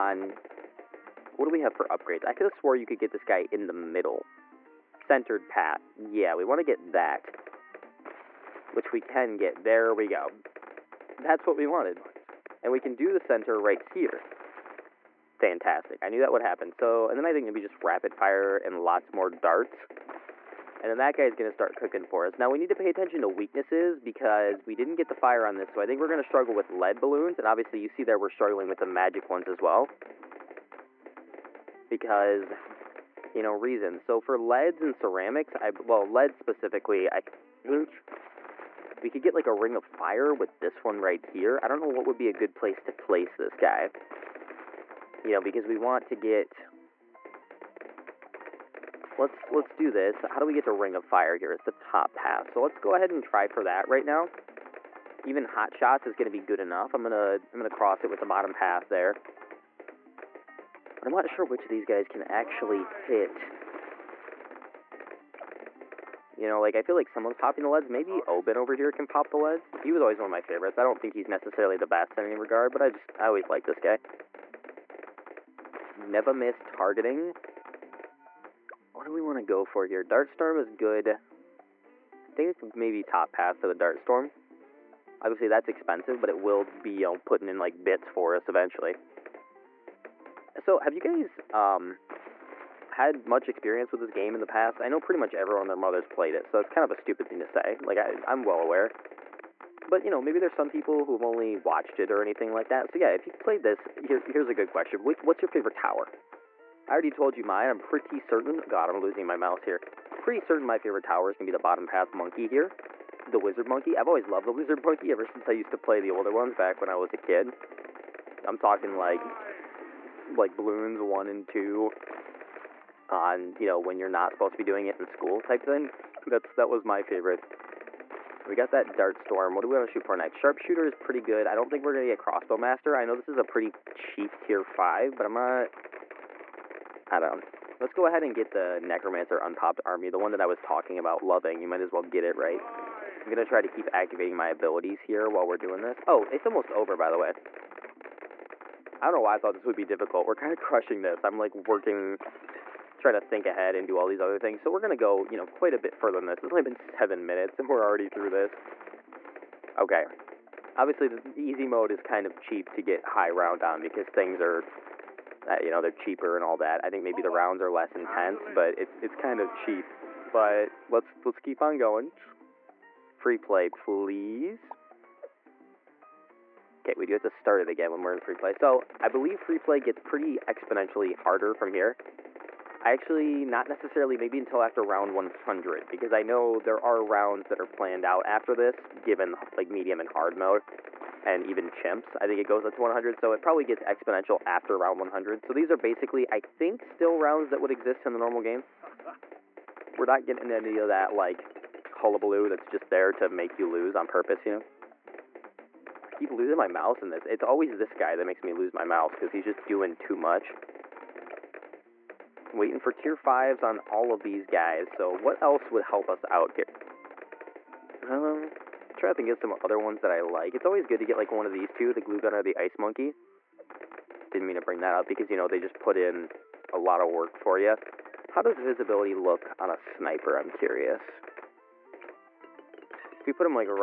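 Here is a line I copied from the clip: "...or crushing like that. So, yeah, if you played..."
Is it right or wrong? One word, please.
wrong.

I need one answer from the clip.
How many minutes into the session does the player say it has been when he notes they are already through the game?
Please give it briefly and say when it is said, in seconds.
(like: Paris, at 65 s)
7, at 156 s.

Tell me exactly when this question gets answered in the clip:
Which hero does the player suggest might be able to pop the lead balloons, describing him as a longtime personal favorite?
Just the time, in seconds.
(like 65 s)
68 s.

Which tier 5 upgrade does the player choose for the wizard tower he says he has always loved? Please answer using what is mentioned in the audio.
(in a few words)
Necromancer Unpopped Army.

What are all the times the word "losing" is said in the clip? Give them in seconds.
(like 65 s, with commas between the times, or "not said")
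108 s, 206 s.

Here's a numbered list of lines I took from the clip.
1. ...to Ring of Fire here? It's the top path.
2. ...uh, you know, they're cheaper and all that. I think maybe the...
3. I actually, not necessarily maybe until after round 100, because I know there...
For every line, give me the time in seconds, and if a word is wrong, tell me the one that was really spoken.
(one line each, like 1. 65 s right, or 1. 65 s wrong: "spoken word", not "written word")
1. 50 s right
2. 165 s right
3. 182 s right.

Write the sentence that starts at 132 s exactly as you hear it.
I know this is a pretty cheap tier 5, but I'm not.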